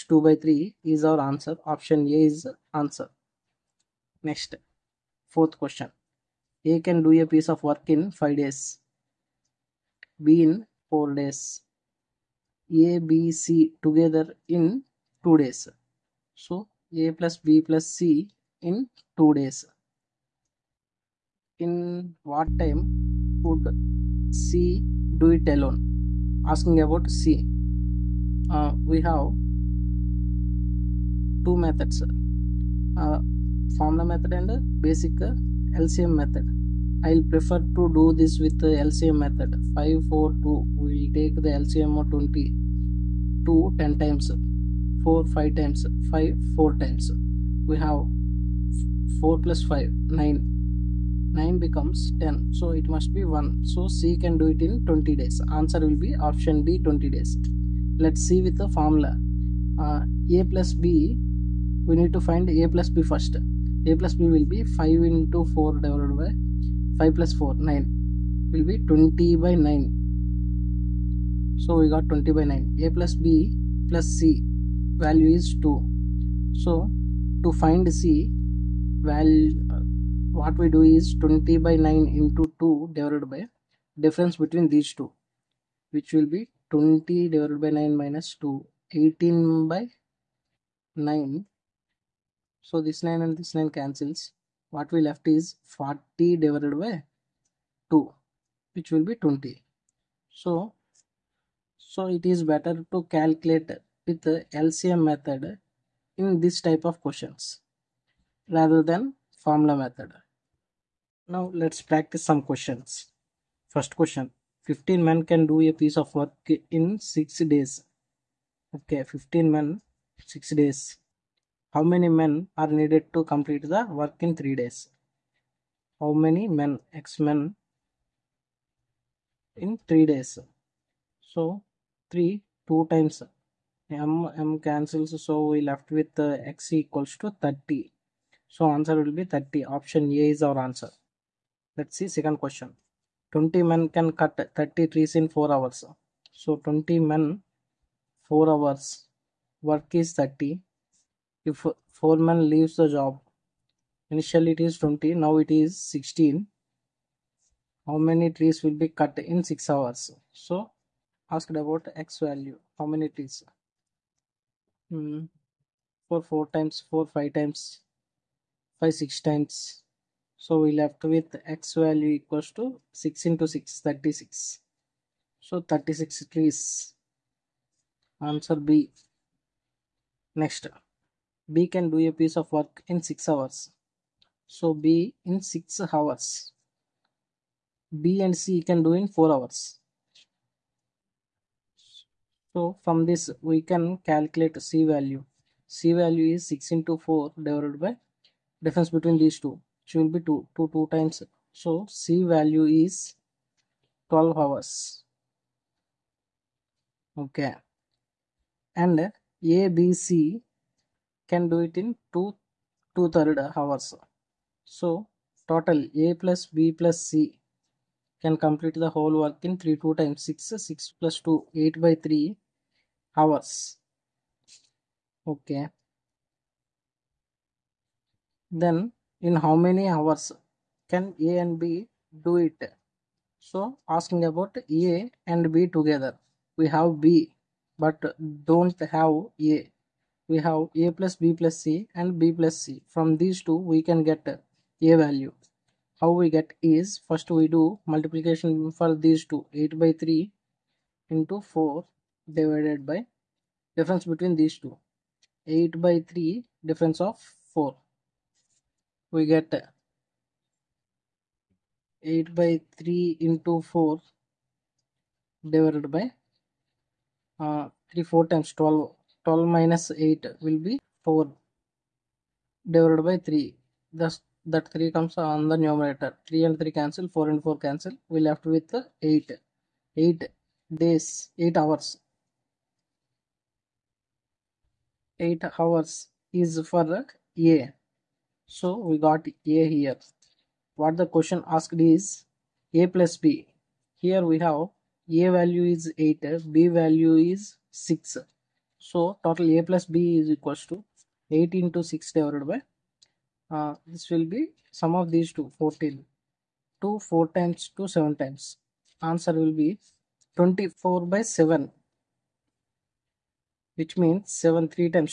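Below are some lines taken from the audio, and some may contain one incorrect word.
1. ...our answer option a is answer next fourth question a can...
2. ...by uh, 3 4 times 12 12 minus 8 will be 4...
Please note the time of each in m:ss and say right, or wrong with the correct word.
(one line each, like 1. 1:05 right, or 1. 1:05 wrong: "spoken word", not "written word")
1. 0:01 right
2. 4:25 right.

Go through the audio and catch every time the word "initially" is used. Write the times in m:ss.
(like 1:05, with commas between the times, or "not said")
2:34.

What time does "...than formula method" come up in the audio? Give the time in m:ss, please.
1:48.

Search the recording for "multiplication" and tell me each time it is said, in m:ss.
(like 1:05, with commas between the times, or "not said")
4:07.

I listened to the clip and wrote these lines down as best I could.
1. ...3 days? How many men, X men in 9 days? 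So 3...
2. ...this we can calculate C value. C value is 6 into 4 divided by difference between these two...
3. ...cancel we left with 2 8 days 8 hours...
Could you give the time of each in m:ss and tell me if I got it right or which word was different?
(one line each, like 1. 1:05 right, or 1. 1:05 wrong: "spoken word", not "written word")
1. 2:04 wrong: "3", not "9"
2. 3:13 right
3. 4:37 wrong: "8", not "2".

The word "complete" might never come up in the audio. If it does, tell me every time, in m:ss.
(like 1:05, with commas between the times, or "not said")
2:03, 3:38.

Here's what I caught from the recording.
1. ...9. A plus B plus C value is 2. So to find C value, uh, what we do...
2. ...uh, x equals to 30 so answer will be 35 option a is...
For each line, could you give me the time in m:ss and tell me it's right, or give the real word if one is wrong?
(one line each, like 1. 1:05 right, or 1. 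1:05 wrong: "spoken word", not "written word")
1. 1:12 right
2. 2:16 wrong: "30", not "35".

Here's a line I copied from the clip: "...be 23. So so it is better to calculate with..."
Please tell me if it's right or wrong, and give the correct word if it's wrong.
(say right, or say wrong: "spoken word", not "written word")
wrong: "20", not "23".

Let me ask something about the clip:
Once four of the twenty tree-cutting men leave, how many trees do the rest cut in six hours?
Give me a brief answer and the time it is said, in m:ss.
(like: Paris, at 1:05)
36, at 2:55.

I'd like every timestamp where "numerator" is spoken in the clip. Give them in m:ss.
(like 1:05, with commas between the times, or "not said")
4:35.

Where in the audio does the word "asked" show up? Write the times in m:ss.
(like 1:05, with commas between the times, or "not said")
2:41, 4:51.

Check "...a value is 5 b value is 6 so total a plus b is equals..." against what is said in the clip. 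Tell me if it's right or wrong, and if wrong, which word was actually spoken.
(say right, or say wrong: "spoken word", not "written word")
wrong: "8", not "5".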